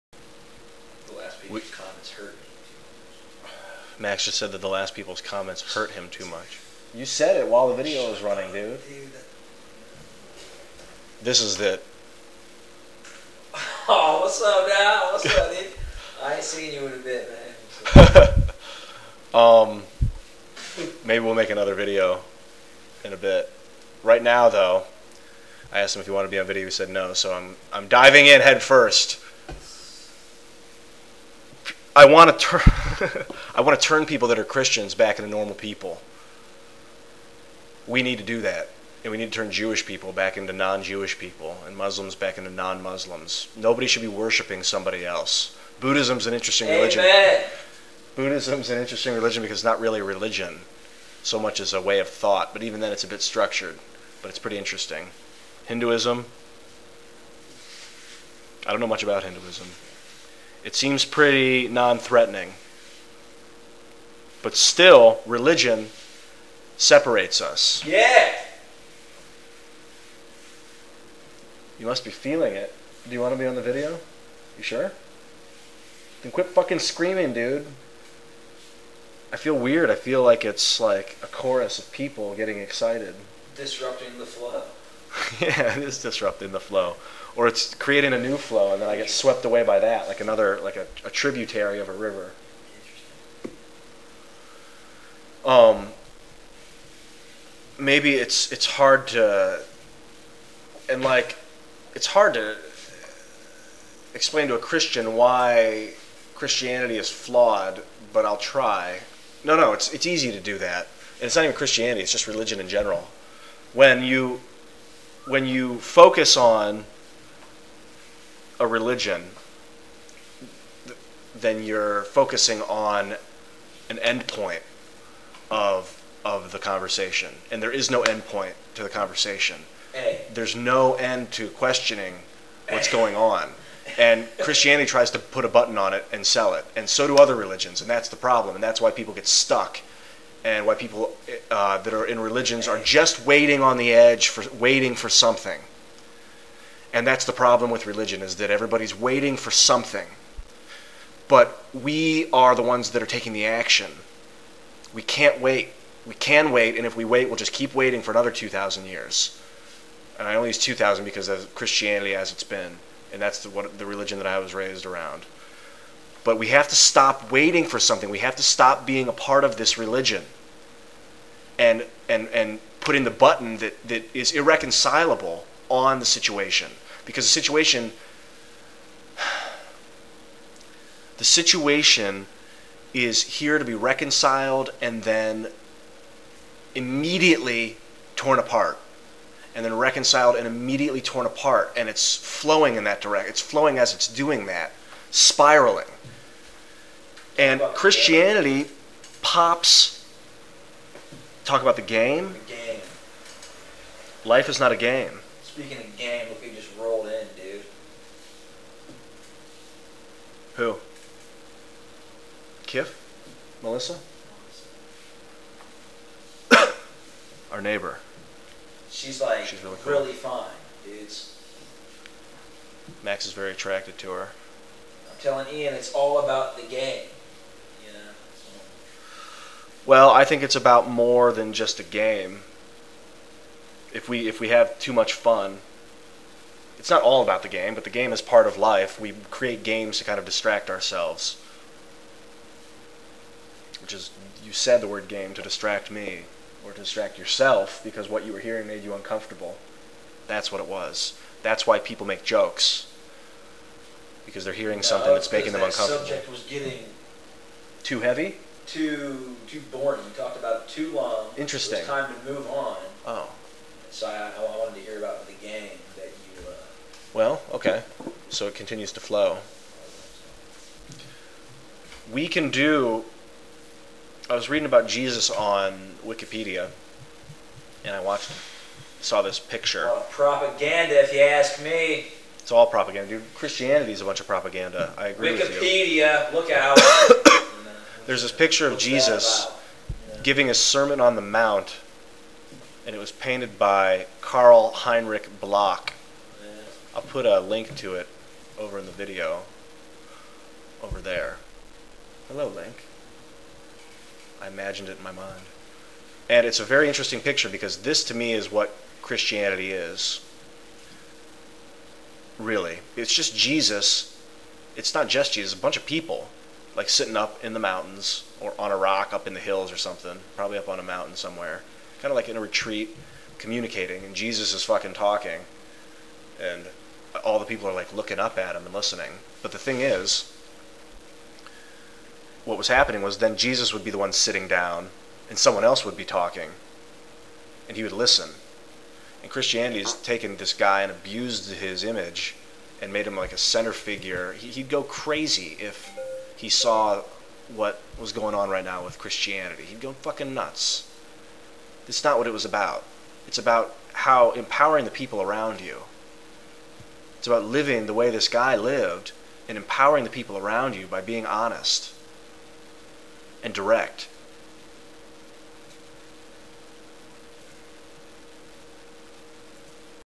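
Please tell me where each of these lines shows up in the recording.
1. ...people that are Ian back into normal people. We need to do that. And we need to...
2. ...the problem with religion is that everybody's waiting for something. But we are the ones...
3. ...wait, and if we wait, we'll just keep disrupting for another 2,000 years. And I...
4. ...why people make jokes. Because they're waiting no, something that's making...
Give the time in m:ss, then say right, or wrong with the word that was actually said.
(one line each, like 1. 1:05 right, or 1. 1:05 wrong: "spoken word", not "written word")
1. 0:34 wrong: "Christians", not "Ian"
2. 2:27 right
3. 2:36 wrong: "waiting", not "disrupting"
4. 4:11 wrong: "hearing", not "waiting".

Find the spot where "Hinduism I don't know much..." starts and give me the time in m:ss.
0:55.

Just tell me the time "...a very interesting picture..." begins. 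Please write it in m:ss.
5:06.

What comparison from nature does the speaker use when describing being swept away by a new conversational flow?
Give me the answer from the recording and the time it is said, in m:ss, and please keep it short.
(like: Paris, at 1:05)
A tributary of a river, at 1:31.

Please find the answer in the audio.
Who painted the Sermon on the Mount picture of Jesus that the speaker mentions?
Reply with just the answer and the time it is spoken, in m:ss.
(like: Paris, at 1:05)
Carl Heinrich Bloch, at 4:54.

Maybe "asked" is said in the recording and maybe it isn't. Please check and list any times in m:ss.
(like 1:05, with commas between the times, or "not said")
0:25.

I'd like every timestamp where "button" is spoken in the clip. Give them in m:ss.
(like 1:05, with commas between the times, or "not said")
2:15, 2:53.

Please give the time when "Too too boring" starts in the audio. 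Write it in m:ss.
4:18.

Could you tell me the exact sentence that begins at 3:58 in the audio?
We create games to kind of distract ourselves.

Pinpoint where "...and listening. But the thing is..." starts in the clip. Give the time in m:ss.
5:28.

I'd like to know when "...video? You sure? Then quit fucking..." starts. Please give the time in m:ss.
1:13.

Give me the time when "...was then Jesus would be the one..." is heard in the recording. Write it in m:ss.
5:33.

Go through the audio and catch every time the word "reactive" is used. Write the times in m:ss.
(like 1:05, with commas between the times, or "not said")
not said.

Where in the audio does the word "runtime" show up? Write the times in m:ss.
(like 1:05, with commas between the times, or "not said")
not said.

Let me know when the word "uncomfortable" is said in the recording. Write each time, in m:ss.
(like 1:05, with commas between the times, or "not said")
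4:08, 4:15.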